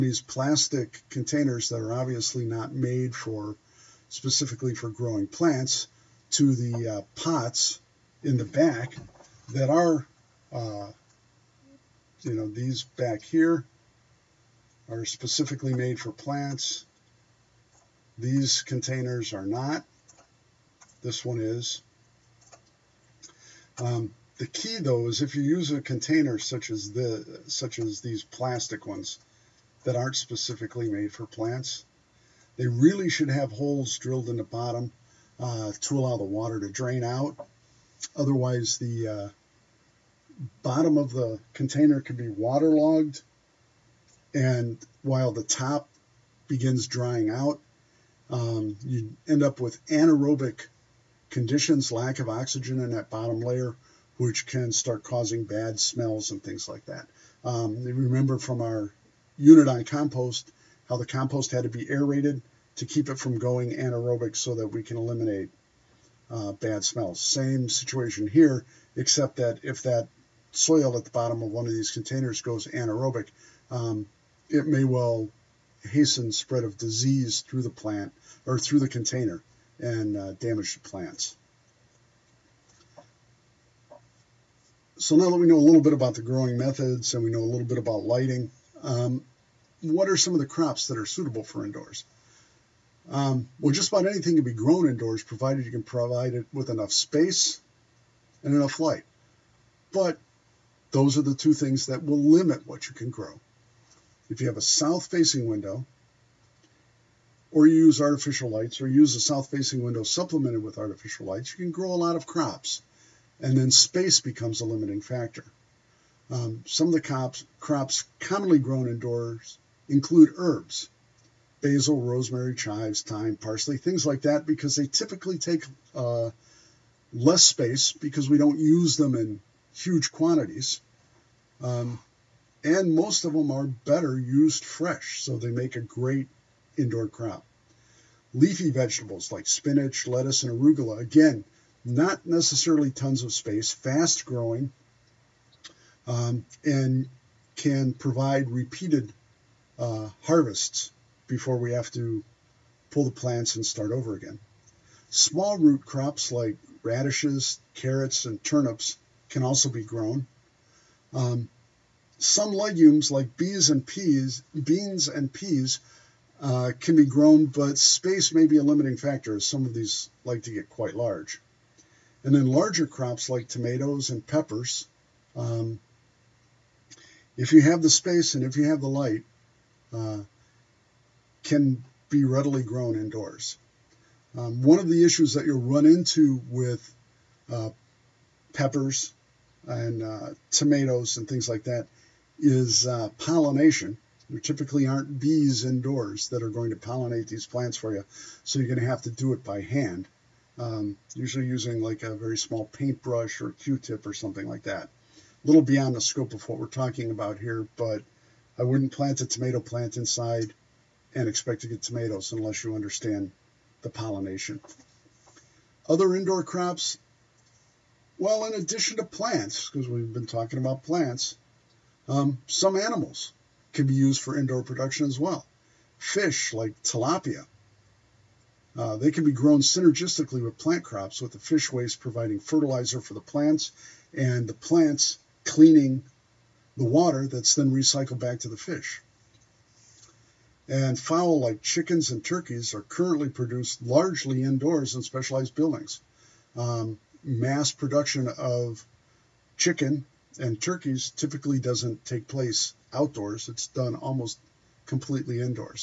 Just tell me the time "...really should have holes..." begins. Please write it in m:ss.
0:32.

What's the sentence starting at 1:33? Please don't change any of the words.
Um, well, just about anything can be grown indoors, provided you can provide it with enough space and enough light.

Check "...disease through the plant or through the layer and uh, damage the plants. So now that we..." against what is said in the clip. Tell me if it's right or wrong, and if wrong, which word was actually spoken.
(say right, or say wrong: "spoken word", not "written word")
wrong: "container", not "layer".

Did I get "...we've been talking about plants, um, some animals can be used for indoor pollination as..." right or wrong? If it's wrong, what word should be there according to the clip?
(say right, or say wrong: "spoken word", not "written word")
wrong: "production", not "pollination".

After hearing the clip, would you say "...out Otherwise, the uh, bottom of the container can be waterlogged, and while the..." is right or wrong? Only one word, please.
right.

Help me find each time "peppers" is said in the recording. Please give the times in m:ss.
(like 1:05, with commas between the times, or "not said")
2:54, 3:08.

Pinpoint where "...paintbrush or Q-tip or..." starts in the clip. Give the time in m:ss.
3:22.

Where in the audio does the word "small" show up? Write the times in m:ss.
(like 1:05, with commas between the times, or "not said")
2:35, 3:22.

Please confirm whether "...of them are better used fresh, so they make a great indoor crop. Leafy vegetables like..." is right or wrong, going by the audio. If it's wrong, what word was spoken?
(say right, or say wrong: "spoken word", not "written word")
right.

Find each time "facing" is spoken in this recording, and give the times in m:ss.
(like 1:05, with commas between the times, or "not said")
1:45, 1:49.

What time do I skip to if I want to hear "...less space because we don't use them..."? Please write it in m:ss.
2:07.